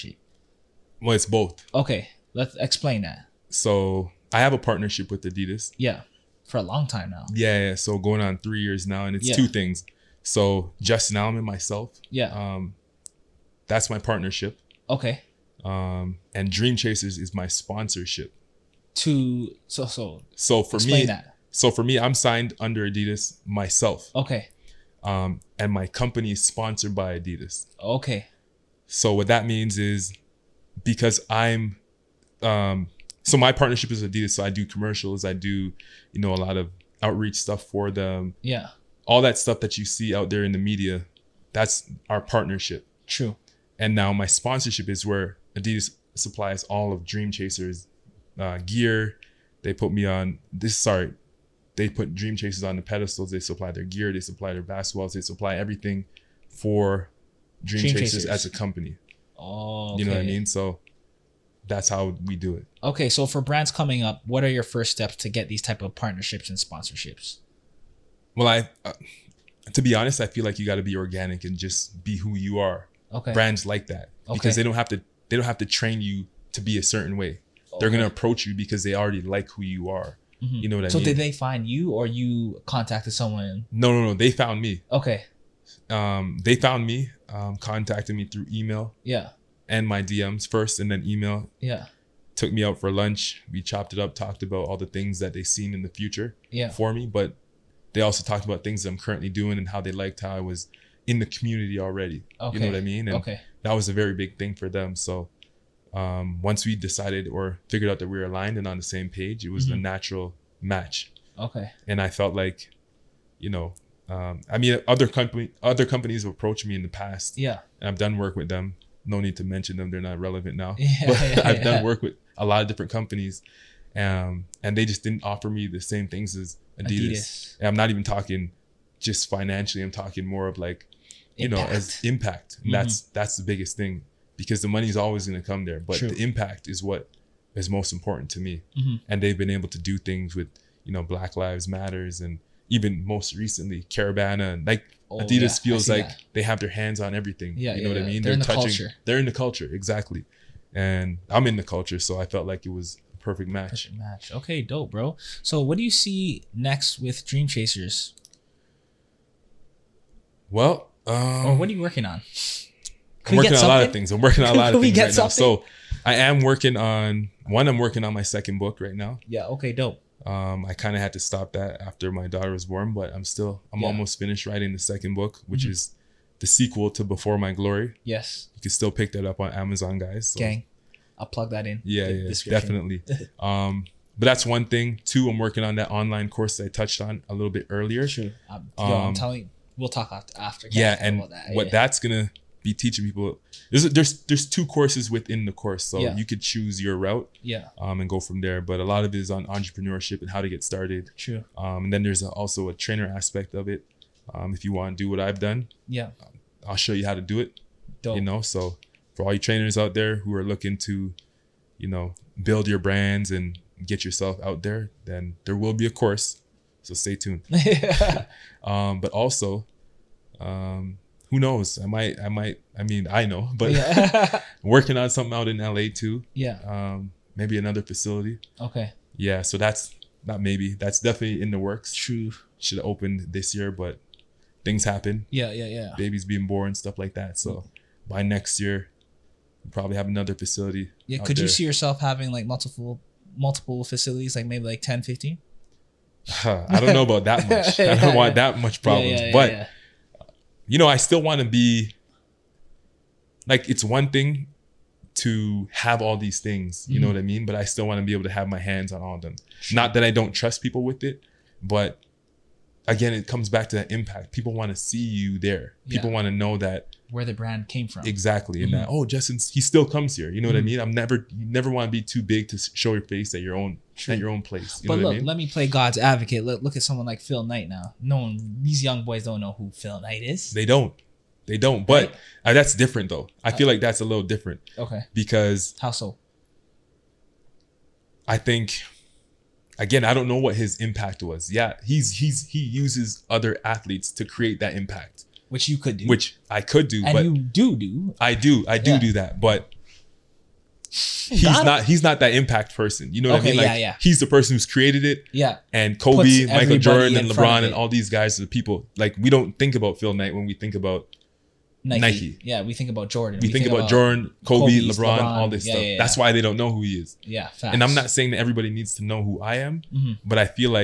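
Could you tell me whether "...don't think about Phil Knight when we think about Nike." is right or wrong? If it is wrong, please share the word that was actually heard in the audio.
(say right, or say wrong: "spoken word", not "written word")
right.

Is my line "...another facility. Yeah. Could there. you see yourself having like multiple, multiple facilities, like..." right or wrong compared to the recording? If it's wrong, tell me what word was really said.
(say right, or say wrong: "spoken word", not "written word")
right.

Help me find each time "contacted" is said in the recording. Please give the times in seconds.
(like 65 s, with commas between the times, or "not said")
82 s, 87 s.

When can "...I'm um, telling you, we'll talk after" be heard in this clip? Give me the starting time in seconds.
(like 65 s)
188 s.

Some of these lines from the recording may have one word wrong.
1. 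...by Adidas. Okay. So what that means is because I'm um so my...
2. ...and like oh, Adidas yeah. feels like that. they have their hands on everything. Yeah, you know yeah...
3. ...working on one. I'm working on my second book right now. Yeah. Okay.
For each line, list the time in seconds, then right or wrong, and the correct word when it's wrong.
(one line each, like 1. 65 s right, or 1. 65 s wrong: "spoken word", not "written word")
1. 26 s right
2. 144 s right
3. 166 s right.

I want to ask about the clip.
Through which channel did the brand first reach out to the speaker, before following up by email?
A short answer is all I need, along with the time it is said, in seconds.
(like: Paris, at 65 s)
DMs, at 89 s.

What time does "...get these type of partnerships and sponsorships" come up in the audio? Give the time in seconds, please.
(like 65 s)
65 s.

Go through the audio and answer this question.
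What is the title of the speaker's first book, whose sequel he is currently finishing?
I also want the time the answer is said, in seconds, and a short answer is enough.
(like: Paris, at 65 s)
Before My Glory, at 177 s.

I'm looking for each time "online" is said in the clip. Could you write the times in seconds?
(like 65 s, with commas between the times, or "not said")
185 s.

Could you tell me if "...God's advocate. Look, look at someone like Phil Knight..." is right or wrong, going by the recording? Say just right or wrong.
right.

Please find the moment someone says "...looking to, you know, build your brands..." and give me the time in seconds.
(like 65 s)
210 s.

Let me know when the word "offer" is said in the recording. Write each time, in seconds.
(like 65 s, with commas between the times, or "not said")
125 s.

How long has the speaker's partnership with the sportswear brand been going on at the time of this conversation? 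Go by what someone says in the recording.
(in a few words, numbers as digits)
3 years.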